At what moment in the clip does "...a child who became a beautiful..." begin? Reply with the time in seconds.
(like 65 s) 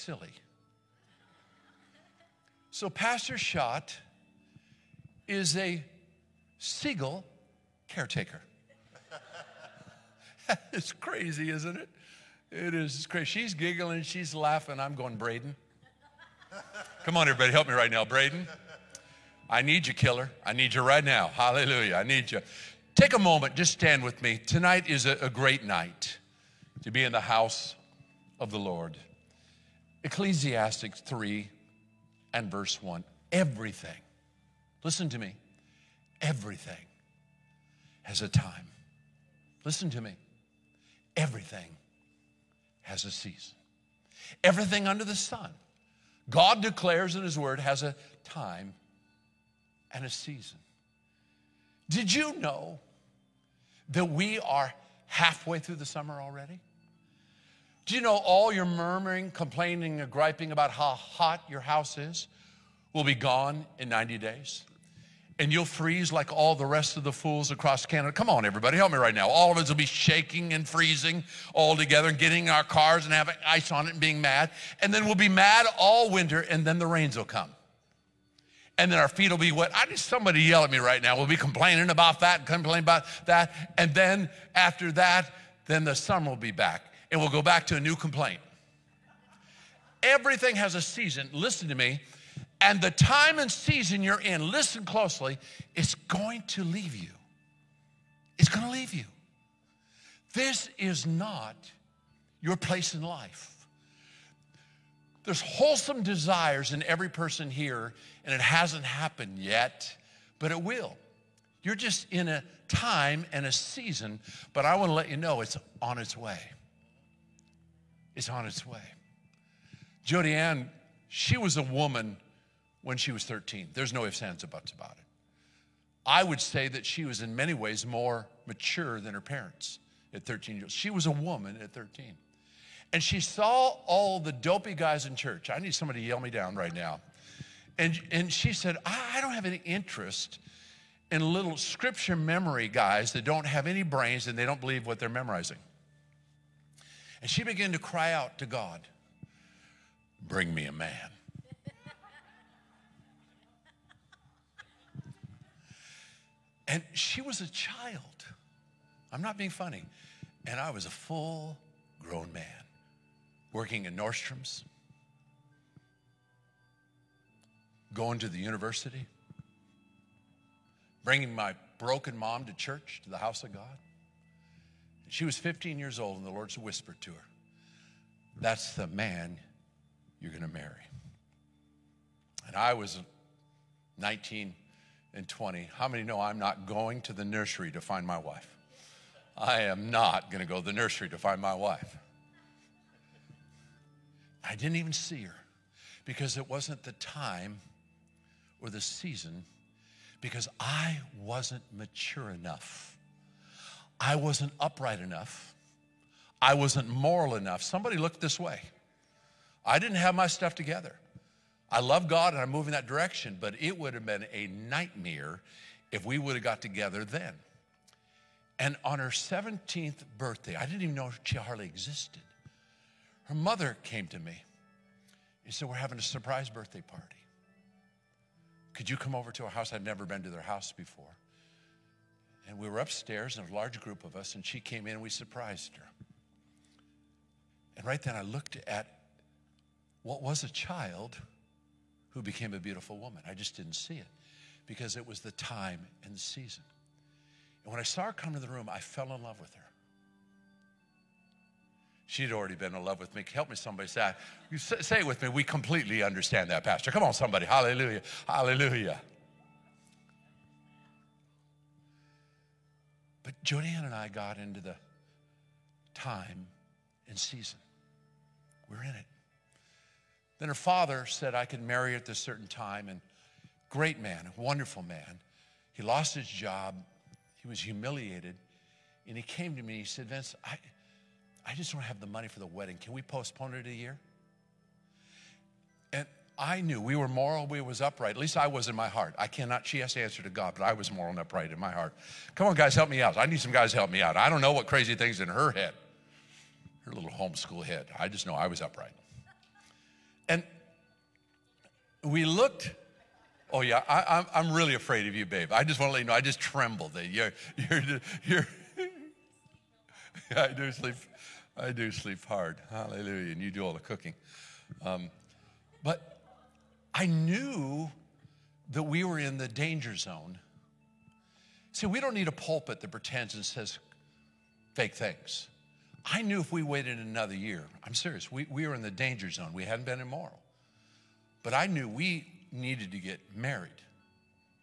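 240 s.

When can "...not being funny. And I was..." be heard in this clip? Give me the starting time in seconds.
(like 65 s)
159 s.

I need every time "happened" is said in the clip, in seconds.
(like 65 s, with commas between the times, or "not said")
108 s.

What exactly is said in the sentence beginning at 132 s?
And she saw all the dopey guys in church.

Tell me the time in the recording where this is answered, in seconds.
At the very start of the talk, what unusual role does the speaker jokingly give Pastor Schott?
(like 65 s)
6 s.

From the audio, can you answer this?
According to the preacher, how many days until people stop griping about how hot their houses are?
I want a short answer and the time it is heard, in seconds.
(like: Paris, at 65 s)
90 days, at 63 s.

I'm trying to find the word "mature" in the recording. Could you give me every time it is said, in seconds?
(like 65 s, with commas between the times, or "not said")
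128 s, 201 s.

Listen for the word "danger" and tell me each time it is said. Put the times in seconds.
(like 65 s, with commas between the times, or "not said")
319 s, 328 s.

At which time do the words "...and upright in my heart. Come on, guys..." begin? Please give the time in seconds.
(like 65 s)
291 s.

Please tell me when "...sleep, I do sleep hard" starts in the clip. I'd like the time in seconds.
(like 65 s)
310 s.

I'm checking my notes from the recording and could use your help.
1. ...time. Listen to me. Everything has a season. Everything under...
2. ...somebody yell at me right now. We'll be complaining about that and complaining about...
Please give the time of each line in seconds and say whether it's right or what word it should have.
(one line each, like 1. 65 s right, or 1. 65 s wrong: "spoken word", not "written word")
1. 38 s right
2. 79 s right.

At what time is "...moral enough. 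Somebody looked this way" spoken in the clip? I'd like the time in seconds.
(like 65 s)
206 s.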